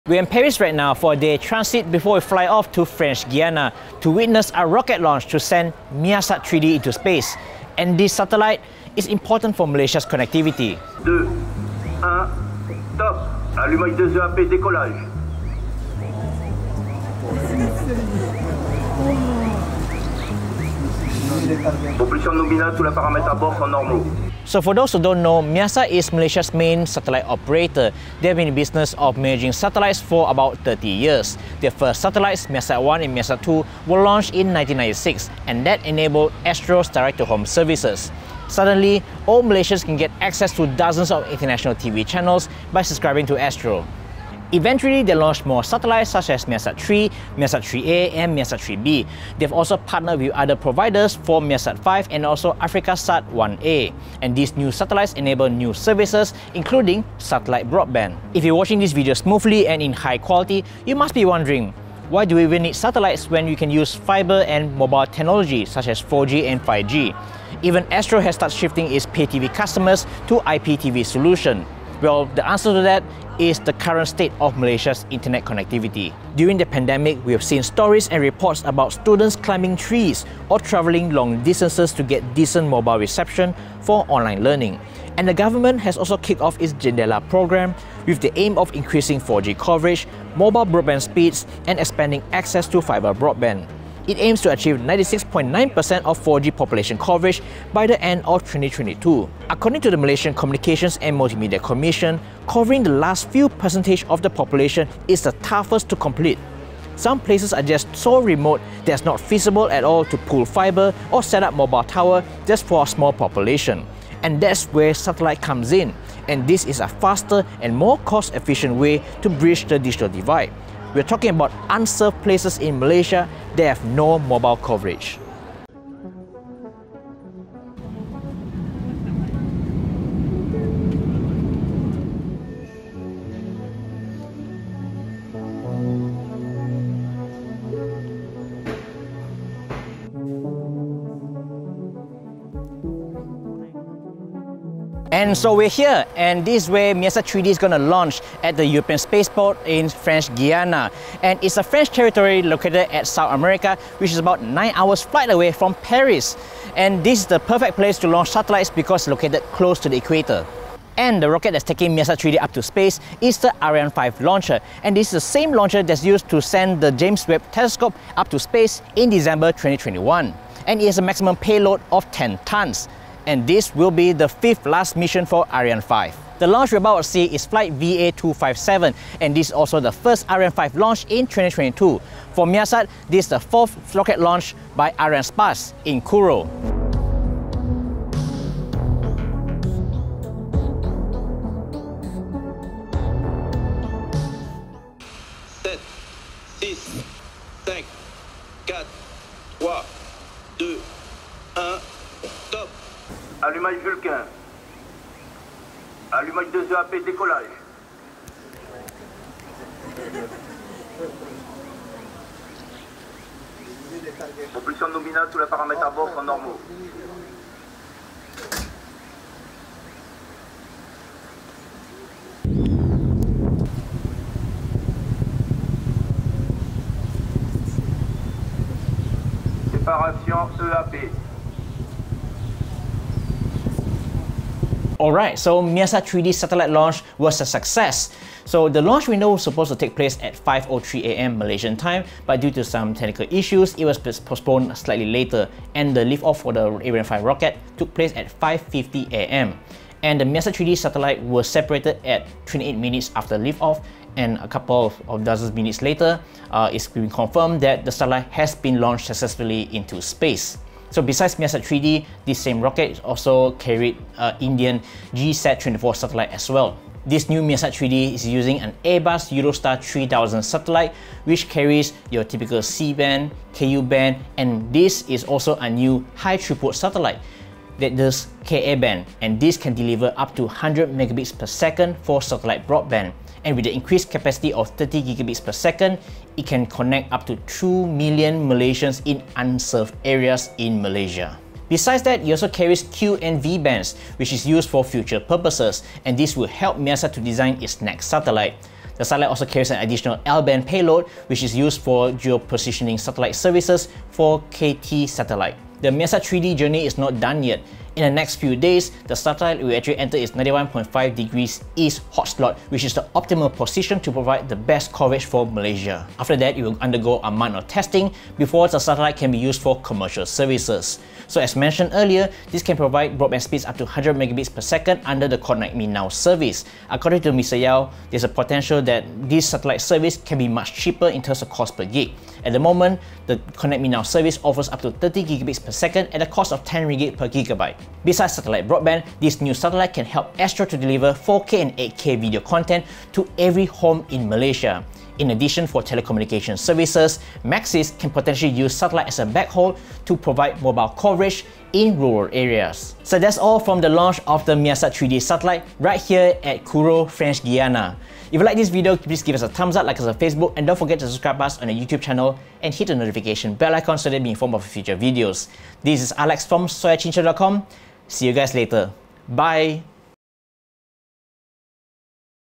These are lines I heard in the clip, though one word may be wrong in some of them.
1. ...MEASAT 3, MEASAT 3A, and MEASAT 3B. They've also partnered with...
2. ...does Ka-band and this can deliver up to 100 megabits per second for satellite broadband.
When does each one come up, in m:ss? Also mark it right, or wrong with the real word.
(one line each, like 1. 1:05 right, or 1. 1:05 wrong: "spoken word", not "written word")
1. 0:46 right
2. 4:37 right.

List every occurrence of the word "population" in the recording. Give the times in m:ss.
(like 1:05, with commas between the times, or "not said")
0:21, 1:36, 1:44, 1:53.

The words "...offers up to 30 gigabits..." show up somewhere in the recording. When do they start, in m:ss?
5:34.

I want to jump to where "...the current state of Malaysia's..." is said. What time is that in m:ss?
1:13.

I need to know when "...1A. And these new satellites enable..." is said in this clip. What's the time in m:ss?
0:53.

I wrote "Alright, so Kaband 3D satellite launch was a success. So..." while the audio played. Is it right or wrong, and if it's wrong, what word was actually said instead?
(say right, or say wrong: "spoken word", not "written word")
wrong: "MEASAT", not "Kaband".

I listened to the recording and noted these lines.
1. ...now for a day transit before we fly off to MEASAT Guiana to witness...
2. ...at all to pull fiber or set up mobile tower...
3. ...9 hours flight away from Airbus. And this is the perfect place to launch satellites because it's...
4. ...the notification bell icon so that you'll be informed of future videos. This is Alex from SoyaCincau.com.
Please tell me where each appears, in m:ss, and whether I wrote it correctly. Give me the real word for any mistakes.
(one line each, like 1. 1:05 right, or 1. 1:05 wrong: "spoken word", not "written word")
1. 0:00 wrong: "French", not "MEASAT"
2. 1:49 right
3. 2:34 wrong: "Paris", not "Airbus"
4. 6:02 right.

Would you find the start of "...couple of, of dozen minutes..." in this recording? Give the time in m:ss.
4:14.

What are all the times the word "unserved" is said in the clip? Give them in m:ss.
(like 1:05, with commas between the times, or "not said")
2:01, 4:49.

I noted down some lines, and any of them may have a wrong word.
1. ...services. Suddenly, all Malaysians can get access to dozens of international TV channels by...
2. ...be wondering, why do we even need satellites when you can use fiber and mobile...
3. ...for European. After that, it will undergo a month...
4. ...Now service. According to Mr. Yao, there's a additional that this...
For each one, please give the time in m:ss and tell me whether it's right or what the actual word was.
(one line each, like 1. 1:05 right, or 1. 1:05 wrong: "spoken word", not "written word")
1. 0:37 right
2. 1:01 right
3. 5:15 wrong: "Malaysia", not "European"
4. 5:25 wrong: "potential", not "additional".